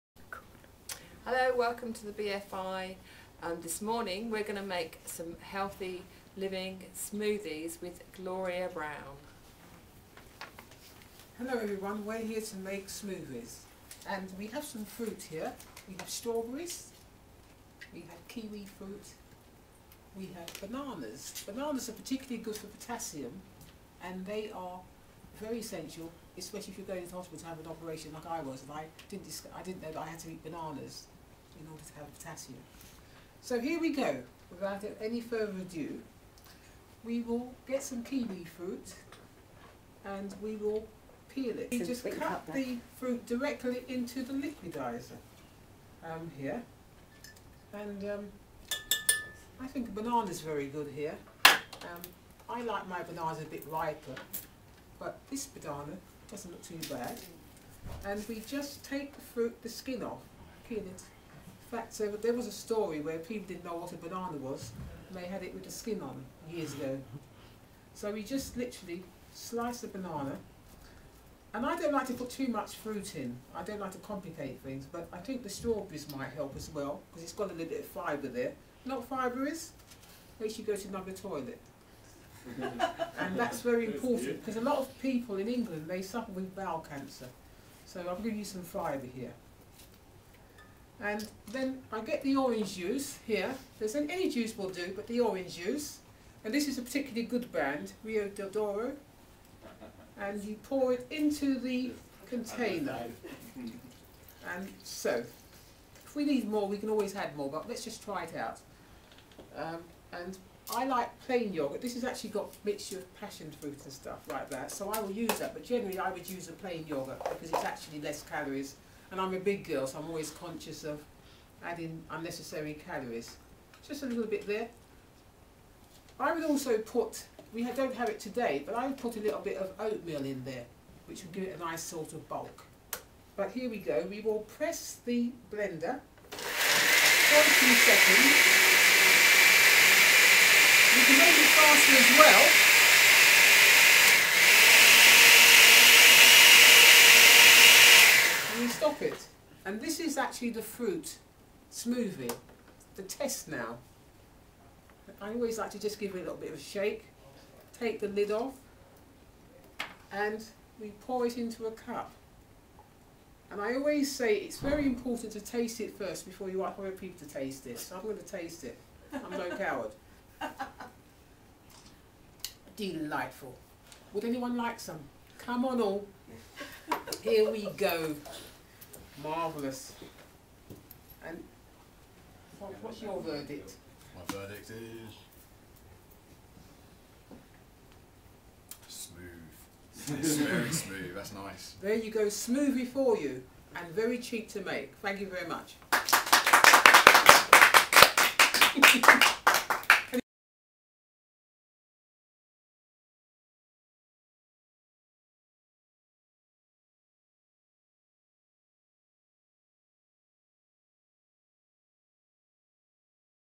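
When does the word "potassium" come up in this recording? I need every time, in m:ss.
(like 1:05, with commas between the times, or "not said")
0:22, 0:32.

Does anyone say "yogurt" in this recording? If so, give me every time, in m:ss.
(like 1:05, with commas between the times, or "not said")
1:51, 1:56.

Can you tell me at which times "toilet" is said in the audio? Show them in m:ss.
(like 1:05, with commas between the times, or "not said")
1:21.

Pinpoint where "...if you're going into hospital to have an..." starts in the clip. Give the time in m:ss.
0:26.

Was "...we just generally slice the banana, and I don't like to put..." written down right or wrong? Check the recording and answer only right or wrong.
wrong.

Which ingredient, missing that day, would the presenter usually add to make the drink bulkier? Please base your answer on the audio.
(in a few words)
Oatmeal.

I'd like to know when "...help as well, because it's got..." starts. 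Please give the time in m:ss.
1:16.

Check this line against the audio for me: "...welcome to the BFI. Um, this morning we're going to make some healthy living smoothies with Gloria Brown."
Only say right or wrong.
right.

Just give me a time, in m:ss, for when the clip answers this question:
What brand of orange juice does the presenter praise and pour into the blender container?
1:38.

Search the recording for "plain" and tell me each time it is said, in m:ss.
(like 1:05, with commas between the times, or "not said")
1:51, 1:56.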